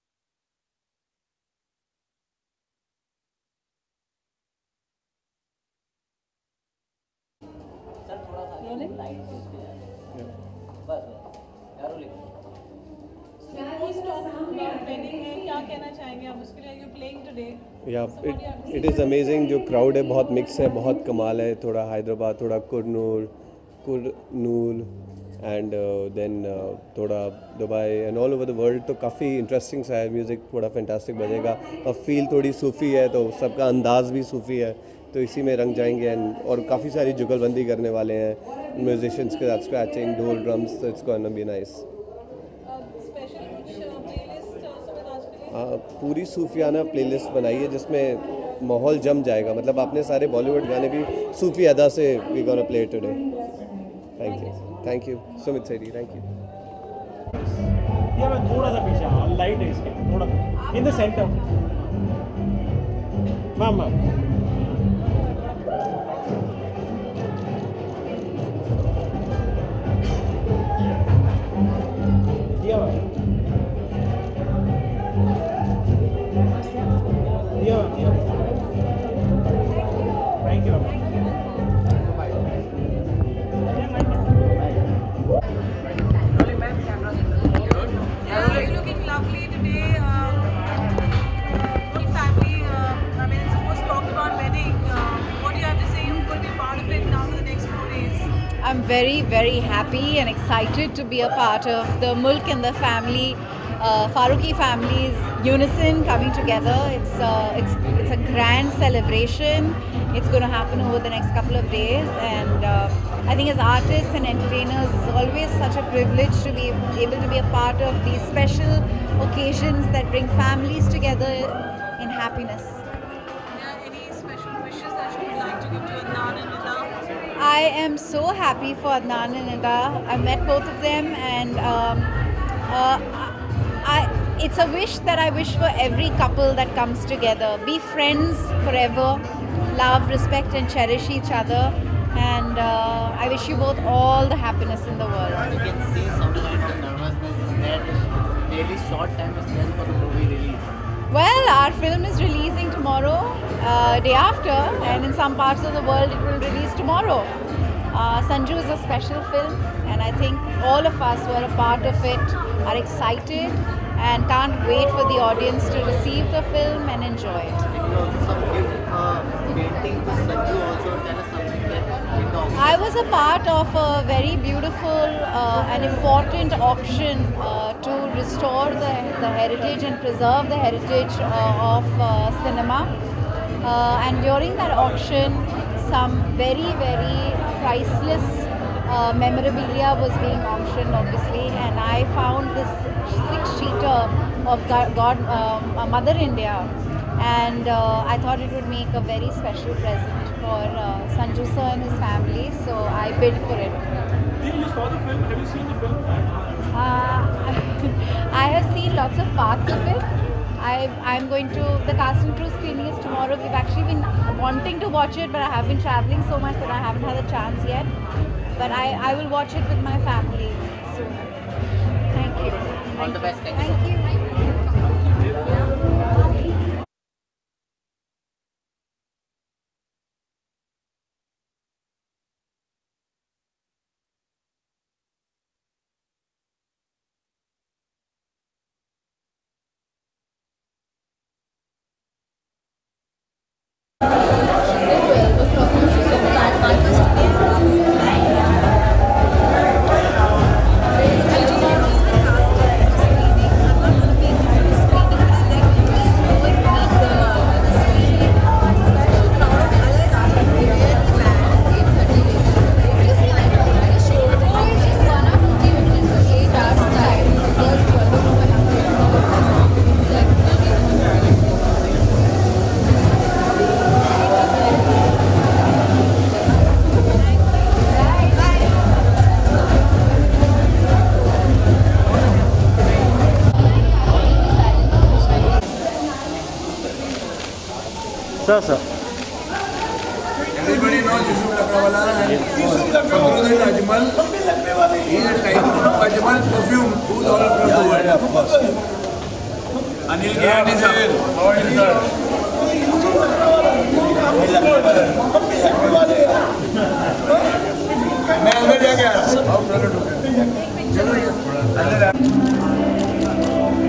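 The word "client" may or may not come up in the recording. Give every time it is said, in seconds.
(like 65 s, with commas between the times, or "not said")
not said.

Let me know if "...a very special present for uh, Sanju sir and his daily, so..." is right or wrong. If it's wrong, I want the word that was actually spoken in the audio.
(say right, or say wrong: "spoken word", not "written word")
wrong: "family", not "daily".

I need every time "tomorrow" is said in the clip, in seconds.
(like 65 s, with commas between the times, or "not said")
152 s, 156 s, 213 s.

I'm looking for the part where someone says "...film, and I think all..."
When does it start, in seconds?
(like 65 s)
159 s.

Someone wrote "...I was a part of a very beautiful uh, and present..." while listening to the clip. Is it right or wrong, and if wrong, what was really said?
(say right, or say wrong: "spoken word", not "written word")
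wrong: "important", not "present".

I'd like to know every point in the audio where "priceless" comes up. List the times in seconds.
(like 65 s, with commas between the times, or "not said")
187 s.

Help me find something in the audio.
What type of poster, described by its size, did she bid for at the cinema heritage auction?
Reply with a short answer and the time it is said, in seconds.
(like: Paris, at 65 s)
six-sheeter, at 193 s.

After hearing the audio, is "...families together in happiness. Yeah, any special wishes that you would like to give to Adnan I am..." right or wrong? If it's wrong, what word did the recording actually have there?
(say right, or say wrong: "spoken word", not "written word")
right.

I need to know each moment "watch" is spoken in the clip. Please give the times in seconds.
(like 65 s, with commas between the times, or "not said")
214 s, 219 s.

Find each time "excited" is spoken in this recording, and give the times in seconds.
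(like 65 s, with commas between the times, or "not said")
100 s, 162 s.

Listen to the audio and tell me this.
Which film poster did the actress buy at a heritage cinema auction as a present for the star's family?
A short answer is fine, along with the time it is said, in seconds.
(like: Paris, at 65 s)
Mother India, at 195 s.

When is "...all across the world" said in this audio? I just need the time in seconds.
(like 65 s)
297 s.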